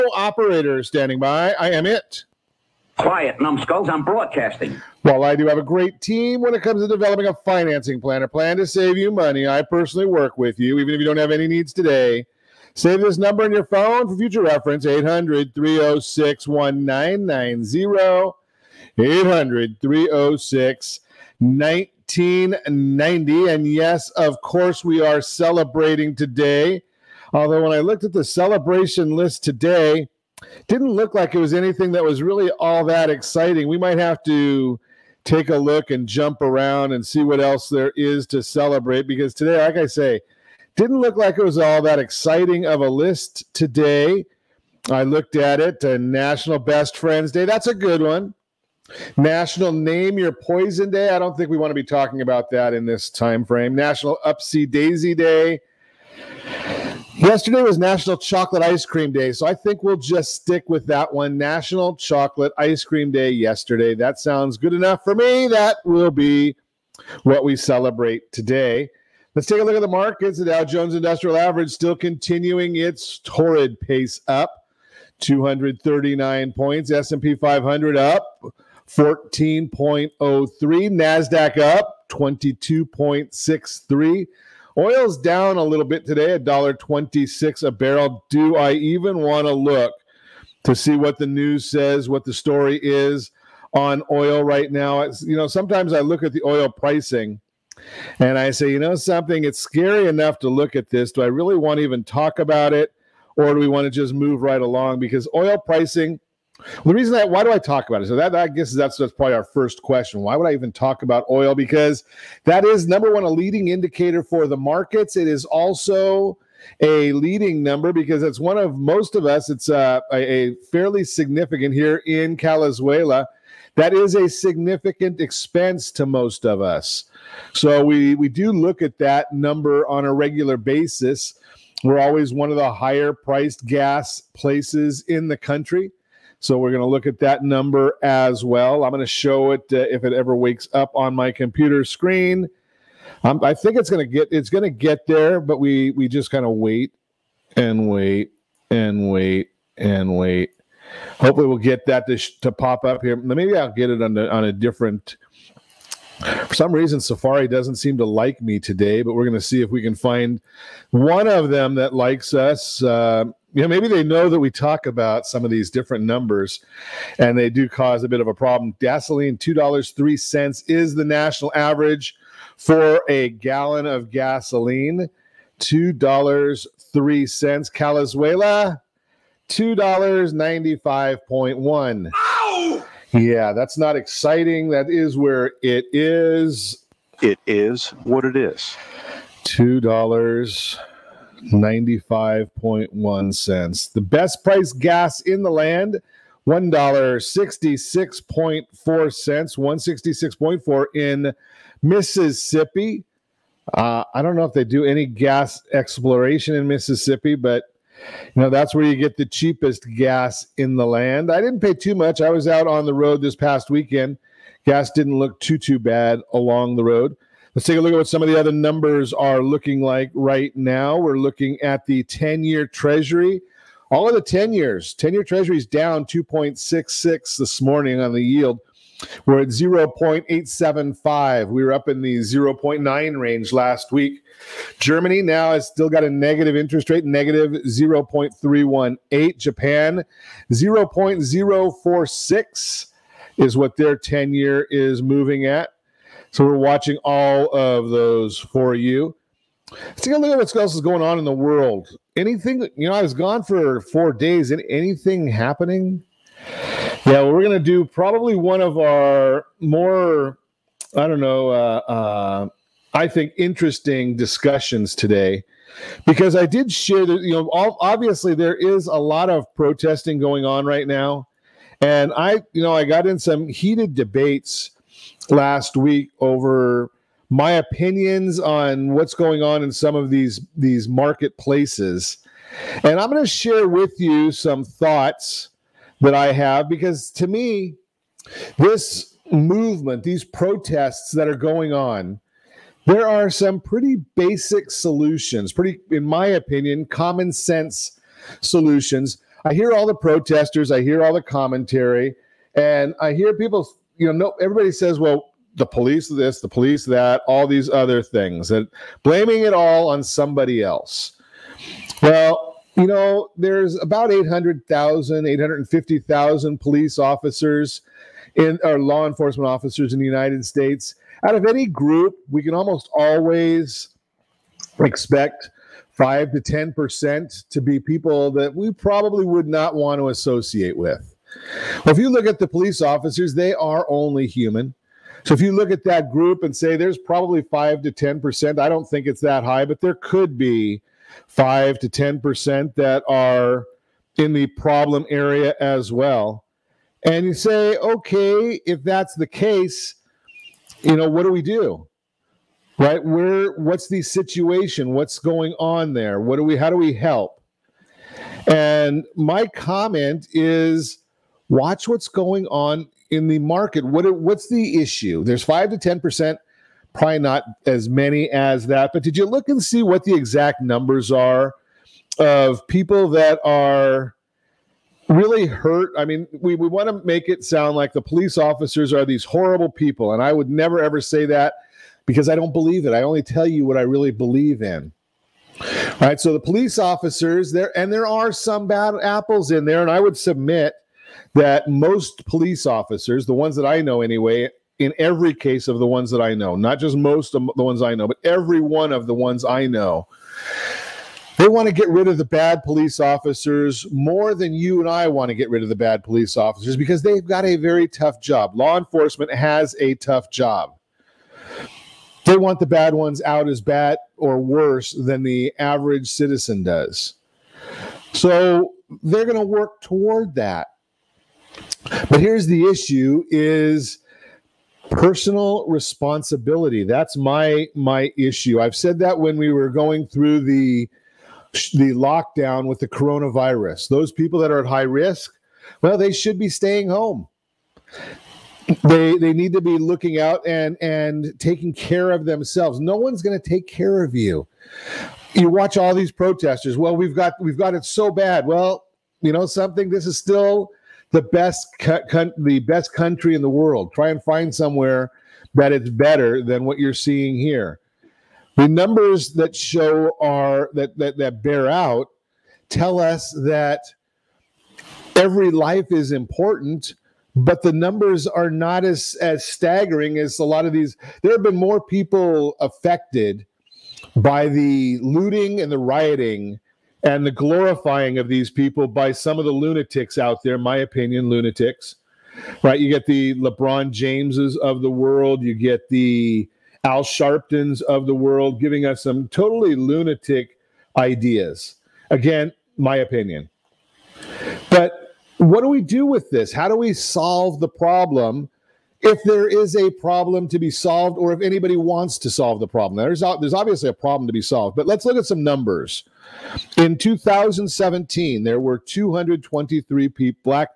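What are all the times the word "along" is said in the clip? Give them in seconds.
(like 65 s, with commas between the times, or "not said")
104 s, 216 s.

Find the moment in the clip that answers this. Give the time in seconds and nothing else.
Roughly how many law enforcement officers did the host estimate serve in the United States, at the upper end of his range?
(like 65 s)
315 s.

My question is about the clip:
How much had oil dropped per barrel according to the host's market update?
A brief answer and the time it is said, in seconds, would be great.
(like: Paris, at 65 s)
$1.26, at 86 s.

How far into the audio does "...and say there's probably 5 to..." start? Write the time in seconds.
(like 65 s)
336 s.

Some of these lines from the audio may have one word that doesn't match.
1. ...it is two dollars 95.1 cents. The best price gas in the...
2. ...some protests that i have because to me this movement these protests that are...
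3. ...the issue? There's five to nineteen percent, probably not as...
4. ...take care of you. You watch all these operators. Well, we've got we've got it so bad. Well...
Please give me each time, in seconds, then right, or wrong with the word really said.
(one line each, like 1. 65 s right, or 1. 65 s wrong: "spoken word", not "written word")
1. 188 s right
2. 284 s wrong: "thoughts", not "protests"
3. 364 s wrong: "ten", not "nineteen"
4. 443 s wrong: "protesters", not "operators".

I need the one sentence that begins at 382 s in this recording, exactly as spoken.
I only tell you what I really believe in.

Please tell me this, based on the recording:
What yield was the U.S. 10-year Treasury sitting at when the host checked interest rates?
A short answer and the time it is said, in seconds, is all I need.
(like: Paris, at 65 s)
0.875, at 229 s.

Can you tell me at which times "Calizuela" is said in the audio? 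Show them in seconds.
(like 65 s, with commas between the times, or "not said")
122 s, 177 s.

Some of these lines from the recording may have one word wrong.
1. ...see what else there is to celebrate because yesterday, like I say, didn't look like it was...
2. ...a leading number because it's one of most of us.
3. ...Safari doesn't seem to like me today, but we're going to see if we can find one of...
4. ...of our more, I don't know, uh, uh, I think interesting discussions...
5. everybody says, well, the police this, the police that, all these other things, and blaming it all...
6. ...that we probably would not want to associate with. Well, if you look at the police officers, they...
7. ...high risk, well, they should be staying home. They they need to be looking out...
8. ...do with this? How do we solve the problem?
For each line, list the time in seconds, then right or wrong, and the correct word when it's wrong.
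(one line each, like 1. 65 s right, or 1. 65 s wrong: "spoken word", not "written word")
1. 37 s wrong: "today", not "yesterday"
2. 116 s right
3. 157 s right
4. 258 s right
5. 304 s right
6. 328 s right
7. 434 s right
8. 495 s right.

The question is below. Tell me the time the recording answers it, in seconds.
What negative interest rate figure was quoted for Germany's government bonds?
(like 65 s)
237 s.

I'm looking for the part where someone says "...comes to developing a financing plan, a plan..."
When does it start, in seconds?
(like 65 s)
6 s.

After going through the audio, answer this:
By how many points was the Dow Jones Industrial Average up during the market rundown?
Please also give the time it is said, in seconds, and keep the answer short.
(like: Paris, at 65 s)
239, at 75 s.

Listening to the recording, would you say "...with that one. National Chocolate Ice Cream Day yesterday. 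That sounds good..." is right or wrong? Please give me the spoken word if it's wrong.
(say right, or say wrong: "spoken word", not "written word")
right.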